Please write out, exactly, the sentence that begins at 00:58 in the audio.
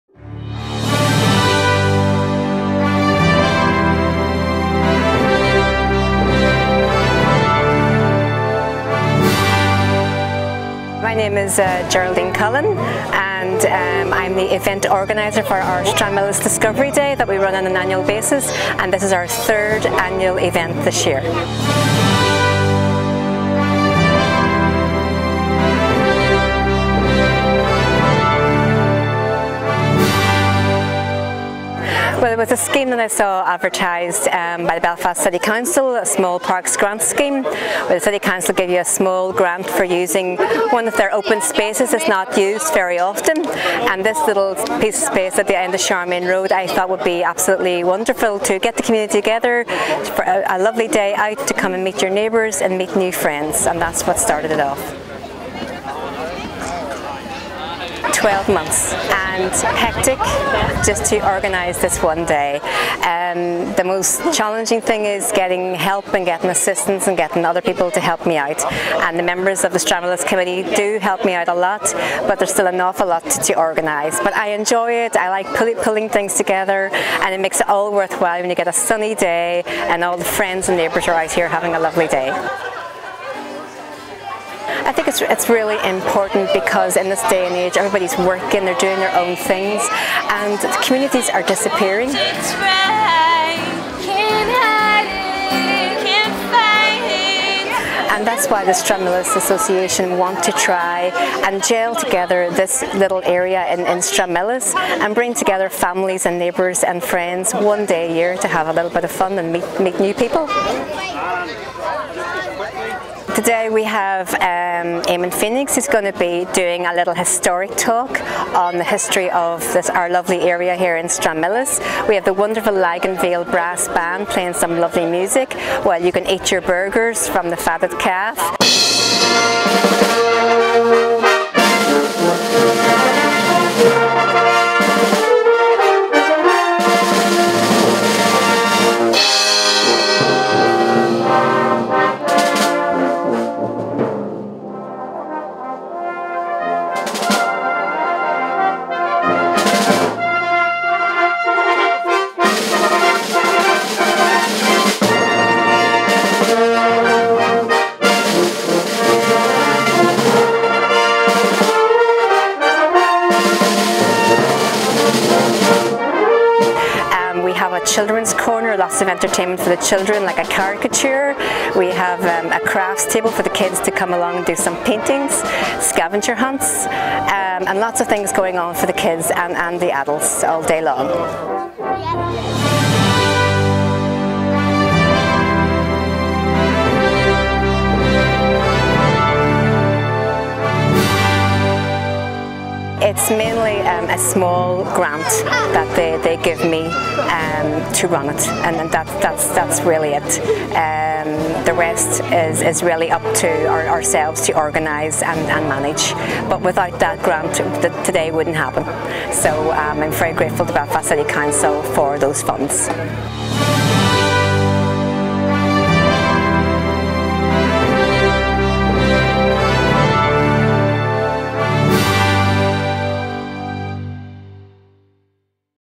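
12 months and hectic just to organize this one day.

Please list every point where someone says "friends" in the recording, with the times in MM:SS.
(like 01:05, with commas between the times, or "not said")
00:53, 01:20, 01:47.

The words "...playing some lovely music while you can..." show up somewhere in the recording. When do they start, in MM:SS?
02:04.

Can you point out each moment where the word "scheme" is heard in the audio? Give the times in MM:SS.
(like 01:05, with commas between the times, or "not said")
00:32, 00:37.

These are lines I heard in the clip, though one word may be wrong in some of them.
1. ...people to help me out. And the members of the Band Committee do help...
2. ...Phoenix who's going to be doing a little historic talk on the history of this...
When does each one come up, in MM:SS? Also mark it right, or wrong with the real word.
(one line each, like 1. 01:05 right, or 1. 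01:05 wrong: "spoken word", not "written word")
1. 01:07 wrong: "Stranmillis", not "Band"
2. 01:55 right.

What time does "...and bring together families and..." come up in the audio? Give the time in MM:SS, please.
01:44.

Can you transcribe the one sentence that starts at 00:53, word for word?
And that's what started it off.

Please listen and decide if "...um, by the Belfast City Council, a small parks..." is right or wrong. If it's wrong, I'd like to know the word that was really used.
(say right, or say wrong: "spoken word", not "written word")
right.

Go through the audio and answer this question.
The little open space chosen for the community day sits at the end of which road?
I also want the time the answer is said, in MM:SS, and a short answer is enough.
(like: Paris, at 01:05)
Sharman Road, at 00:45.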